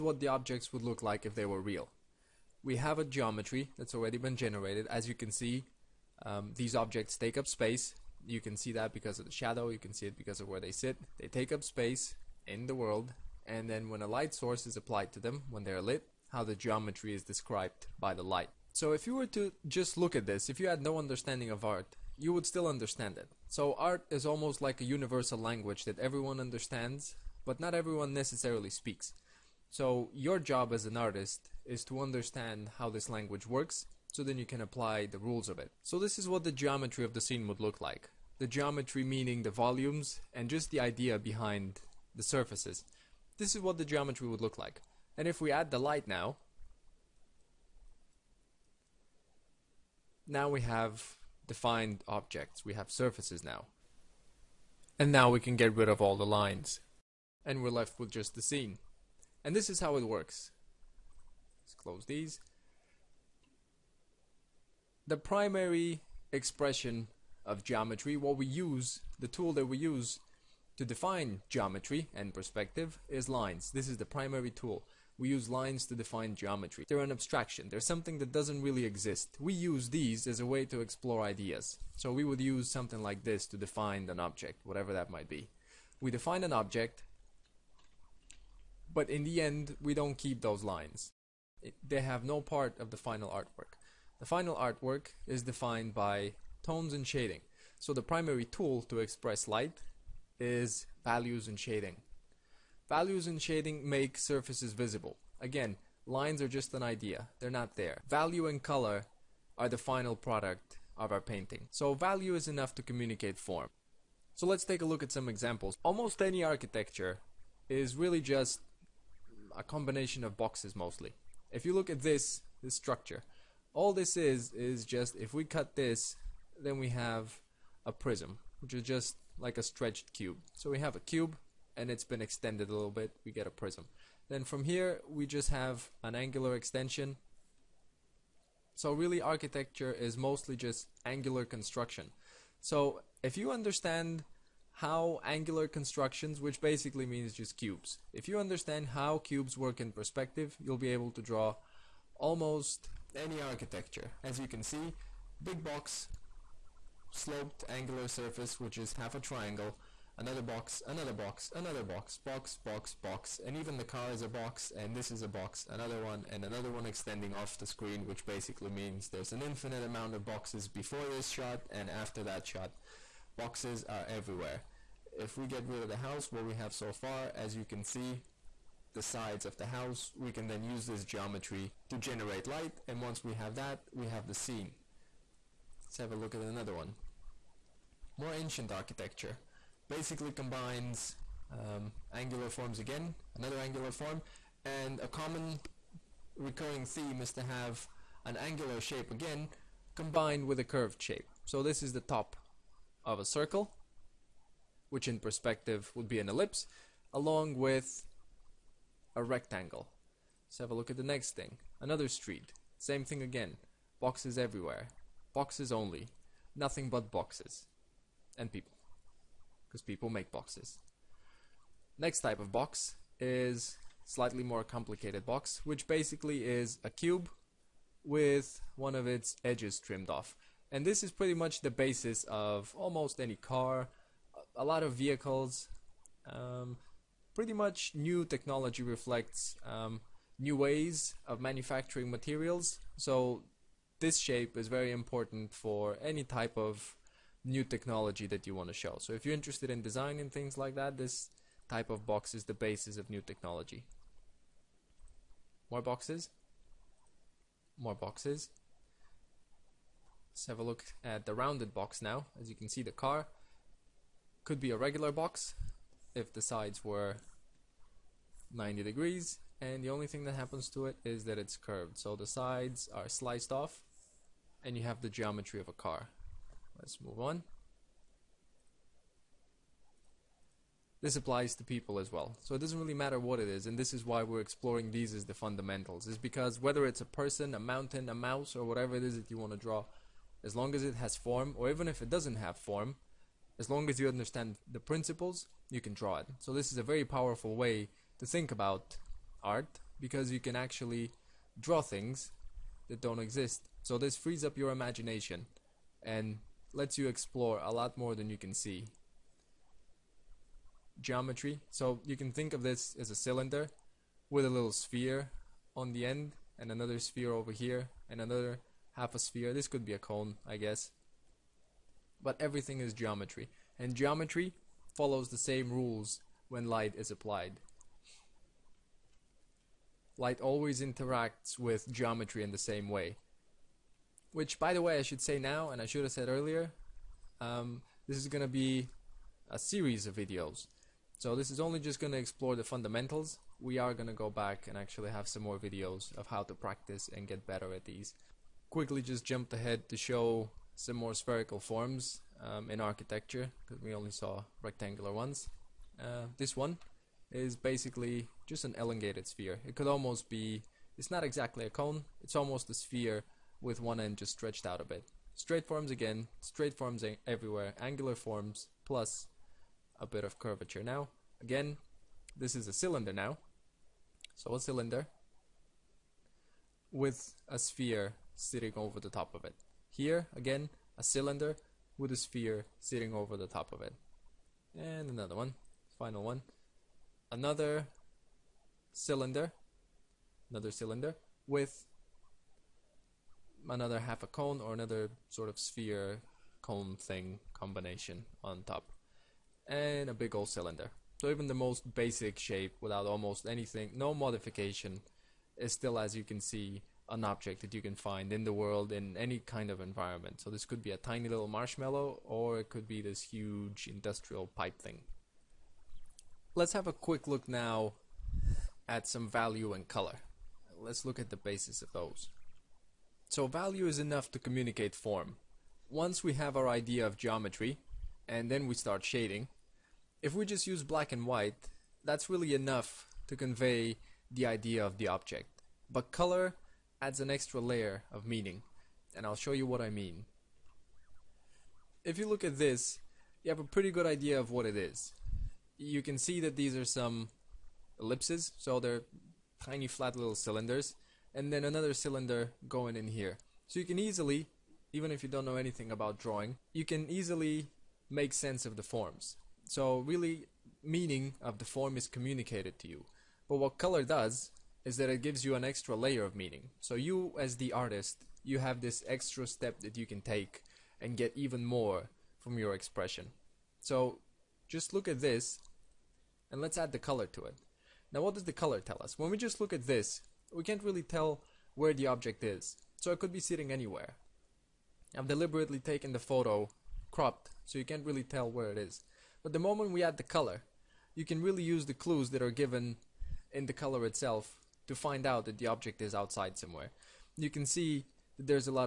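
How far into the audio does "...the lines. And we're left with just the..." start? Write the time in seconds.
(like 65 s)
56 s.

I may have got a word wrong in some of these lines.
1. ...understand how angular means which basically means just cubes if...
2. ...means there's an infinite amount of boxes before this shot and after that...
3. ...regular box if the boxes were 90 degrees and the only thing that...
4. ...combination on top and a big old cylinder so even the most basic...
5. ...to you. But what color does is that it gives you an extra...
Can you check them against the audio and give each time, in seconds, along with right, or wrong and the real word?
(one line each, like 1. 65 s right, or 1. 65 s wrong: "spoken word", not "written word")
1. 143 s wrong: "constructions", not "means"
2. 168 s right
3. 264 s wrong: "sides", not "boxes"
4. 397 s right
5. 462 s right.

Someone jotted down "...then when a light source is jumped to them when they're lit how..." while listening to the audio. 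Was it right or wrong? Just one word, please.
wrong.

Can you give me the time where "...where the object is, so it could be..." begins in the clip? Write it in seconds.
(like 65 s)
481 s.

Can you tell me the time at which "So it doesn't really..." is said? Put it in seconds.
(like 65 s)
282 s.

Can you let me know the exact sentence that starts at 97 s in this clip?
So the primary tool to express light is values and shading.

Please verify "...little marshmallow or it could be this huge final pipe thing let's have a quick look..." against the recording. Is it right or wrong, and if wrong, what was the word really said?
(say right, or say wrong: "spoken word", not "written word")
wrong: "industrial", not "final".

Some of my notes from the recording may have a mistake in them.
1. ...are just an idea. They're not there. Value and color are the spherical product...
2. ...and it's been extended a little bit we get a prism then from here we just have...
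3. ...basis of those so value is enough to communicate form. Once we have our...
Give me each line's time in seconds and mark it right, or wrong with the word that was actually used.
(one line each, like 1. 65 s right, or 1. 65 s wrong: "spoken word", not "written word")
1. 106 s wrong: "final", not "spherical"
2. 131 s right
3. 421 s right.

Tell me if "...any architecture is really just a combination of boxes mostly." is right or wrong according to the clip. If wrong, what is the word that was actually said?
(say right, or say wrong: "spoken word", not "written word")
right.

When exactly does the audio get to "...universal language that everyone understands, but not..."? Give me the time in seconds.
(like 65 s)
24 s.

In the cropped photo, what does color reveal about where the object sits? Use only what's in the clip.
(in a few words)
outside.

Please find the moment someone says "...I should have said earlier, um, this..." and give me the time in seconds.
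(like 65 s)
335 s.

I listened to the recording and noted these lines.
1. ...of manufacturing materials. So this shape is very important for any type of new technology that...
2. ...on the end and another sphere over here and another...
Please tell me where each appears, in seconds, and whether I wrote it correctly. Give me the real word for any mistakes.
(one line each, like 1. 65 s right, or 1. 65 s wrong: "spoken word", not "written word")
1. 241 s right
2. 315 s right.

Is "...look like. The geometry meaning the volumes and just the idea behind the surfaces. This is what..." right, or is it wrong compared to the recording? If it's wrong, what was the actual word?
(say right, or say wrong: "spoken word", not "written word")
right.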